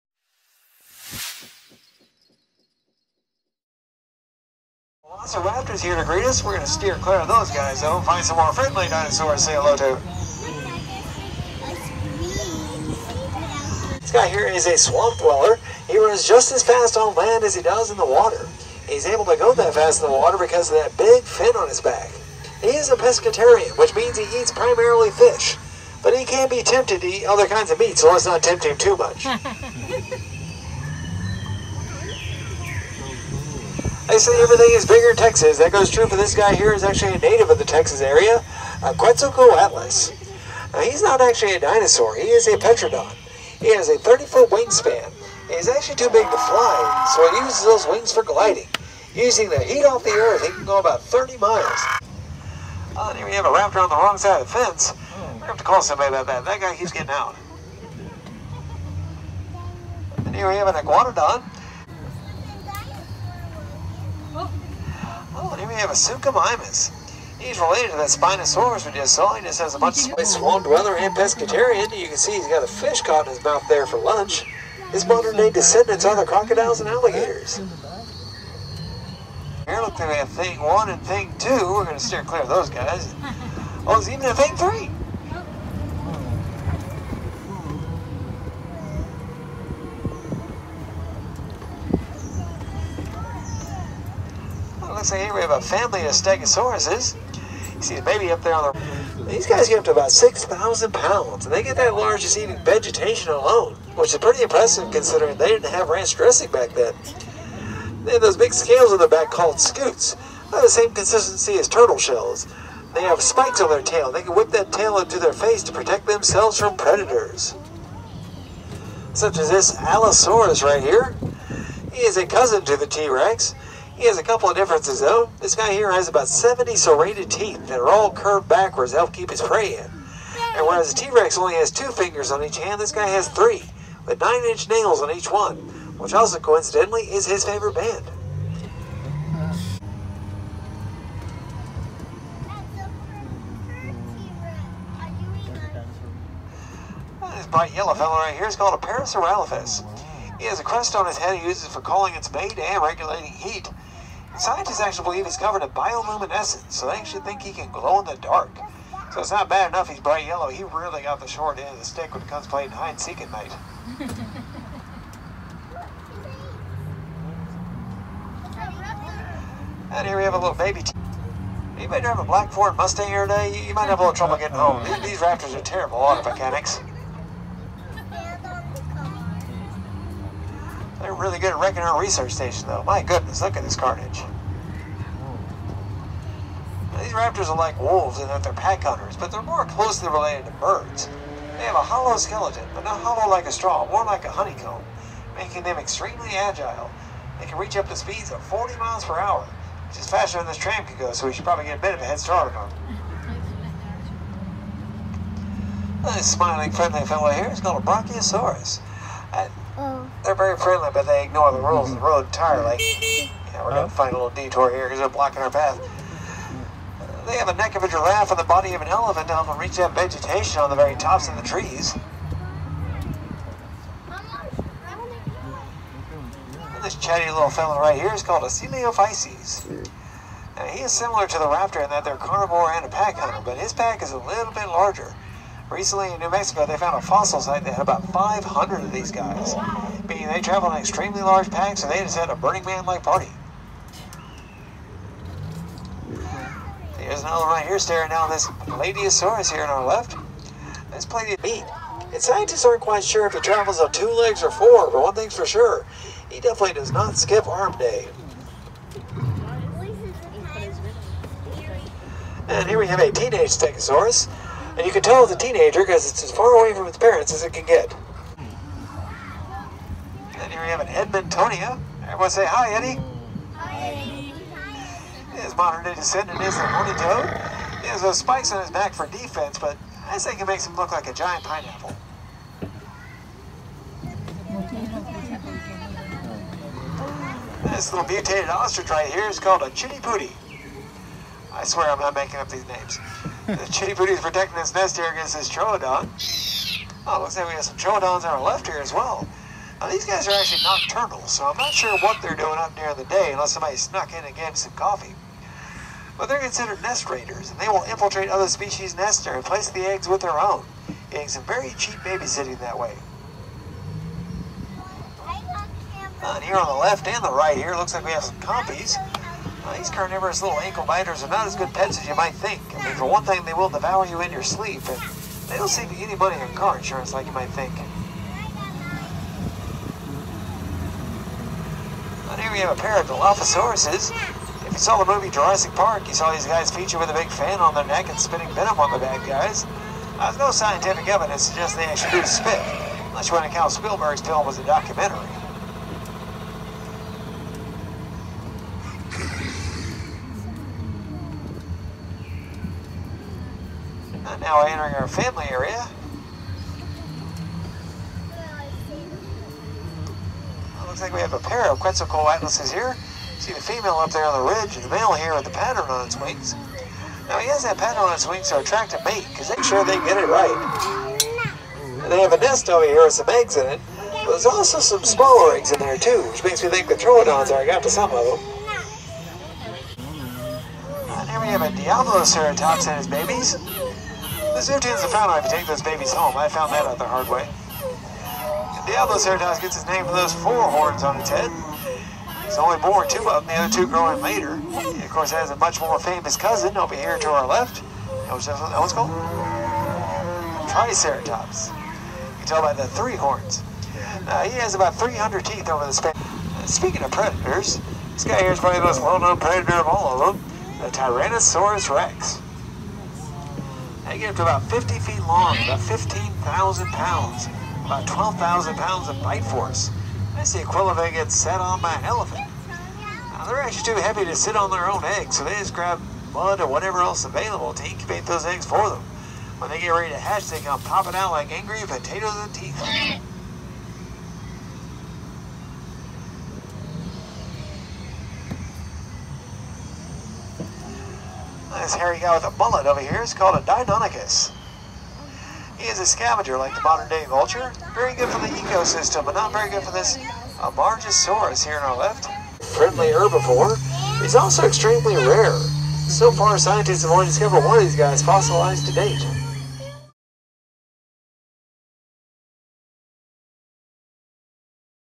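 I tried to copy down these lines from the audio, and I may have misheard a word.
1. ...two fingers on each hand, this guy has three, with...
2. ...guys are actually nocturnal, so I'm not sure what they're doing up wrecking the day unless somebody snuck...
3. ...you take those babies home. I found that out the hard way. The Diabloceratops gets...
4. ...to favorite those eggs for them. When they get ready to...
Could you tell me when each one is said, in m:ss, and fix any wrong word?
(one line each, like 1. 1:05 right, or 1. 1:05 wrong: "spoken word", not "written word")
1. 2:11 right
2. 5:00 wrong: "during", not "wrecking"
3. 6:25 right
4. 7:07 wrong: "incubate", not "favorite".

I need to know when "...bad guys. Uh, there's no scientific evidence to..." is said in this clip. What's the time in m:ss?
5:38.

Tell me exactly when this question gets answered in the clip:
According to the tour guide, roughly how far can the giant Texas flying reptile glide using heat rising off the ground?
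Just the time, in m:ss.
0:51.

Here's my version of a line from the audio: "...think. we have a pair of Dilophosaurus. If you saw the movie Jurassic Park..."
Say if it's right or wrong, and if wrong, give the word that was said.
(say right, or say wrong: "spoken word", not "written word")
right.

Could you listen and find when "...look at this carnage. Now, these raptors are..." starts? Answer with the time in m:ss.
3:03.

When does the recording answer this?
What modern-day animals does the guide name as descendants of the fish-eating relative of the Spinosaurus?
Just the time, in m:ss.
1:16.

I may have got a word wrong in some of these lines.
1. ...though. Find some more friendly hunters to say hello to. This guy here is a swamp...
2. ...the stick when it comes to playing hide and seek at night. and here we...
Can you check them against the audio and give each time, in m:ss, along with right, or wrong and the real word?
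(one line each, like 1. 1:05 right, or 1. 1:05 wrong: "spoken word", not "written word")
1. 0:07 wrong: "dinosaurs", not "hunters"
2. 2:41 right.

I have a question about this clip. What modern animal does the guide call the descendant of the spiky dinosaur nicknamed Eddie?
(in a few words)
horny toad.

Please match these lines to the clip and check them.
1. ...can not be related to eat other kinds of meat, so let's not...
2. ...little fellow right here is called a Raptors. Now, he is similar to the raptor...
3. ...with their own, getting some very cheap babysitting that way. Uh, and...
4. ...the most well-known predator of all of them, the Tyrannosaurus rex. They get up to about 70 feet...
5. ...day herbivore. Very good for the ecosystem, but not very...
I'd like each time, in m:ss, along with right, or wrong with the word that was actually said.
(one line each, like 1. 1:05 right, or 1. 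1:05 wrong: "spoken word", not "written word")
1. 0:26 wrong: "tempted", not "related"
2. 3:47 wrong: "Coelophysis", not "Raptors"
3. 5:10 right
4. 6:48 wrong: "50", not "70"
5. 7:27 wrong: "vulture", not "herbivore".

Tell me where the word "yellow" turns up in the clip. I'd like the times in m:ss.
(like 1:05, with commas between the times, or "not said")
2:27, 2:40.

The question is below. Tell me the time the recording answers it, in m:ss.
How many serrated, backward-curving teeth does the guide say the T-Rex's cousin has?
2:06.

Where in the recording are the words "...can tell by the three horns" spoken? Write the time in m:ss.
6:42.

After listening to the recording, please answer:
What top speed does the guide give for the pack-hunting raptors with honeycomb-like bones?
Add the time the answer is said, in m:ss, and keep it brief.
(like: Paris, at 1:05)
40 miles per hour, at 3:18.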